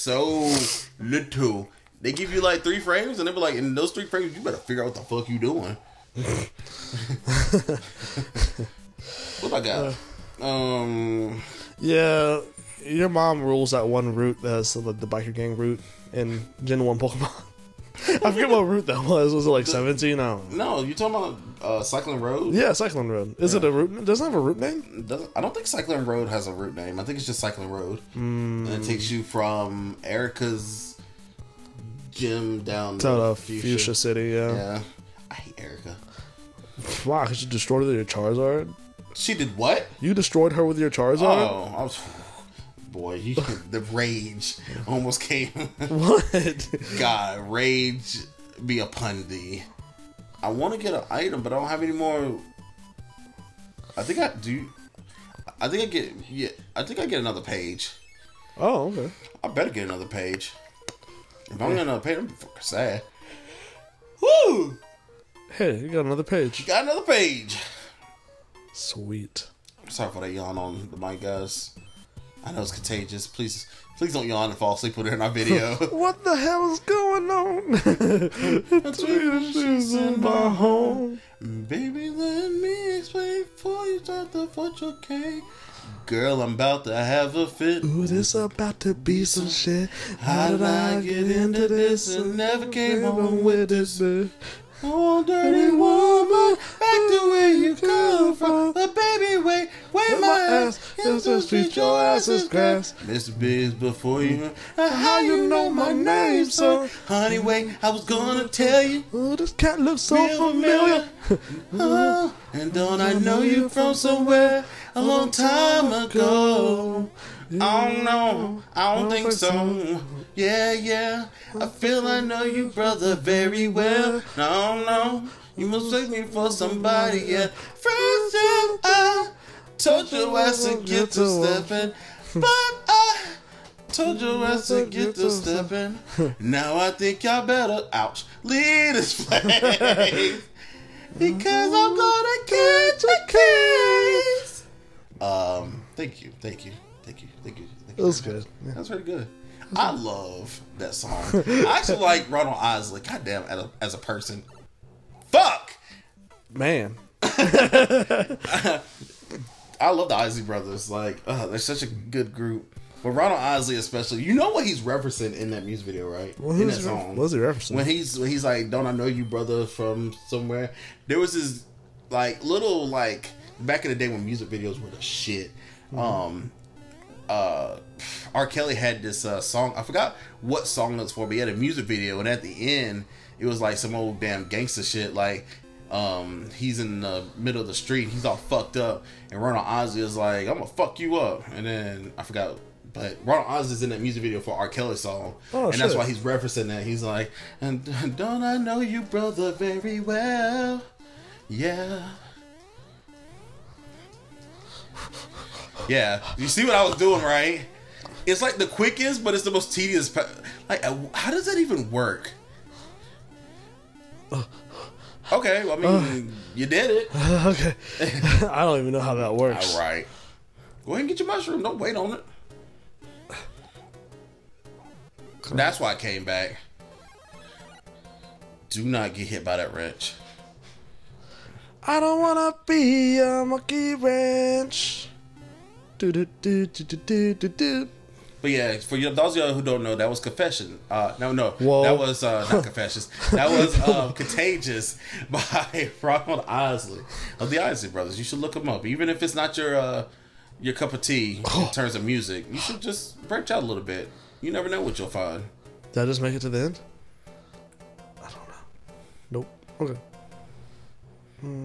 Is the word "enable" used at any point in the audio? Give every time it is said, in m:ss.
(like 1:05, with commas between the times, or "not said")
not said.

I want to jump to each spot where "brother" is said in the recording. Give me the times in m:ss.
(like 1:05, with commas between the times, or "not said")
2:02, 2:40, 2:49, 3:19, 4:07.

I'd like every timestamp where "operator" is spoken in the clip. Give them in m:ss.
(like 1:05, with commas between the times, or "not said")
not said.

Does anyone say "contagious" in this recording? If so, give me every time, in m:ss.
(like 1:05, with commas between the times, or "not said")
1:12, 4:04.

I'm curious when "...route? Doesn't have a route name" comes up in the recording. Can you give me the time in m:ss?
0:23.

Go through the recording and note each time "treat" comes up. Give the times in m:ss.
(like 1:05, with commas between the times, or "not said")
1:41.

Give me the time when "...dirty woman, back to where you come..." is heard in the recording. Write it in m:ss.
1:35.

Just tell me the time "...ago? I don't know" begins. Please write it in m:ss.
1:55.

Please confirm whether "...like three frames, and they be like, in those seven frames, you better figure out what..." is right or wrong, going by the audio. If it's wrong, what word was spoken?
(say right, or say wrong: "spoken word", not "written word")
wrong: "three", not "seven".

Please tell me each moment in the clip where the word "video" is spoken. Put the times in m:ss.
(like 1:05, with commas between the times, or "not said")
1:15, 2:45, 2:54, 3:01, 3:14.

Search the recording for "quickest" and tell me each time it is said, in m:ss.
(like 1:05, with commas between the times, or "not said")
3:28.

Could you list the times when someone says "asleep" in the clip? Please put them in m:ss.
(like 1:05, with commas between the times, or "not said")
1:14.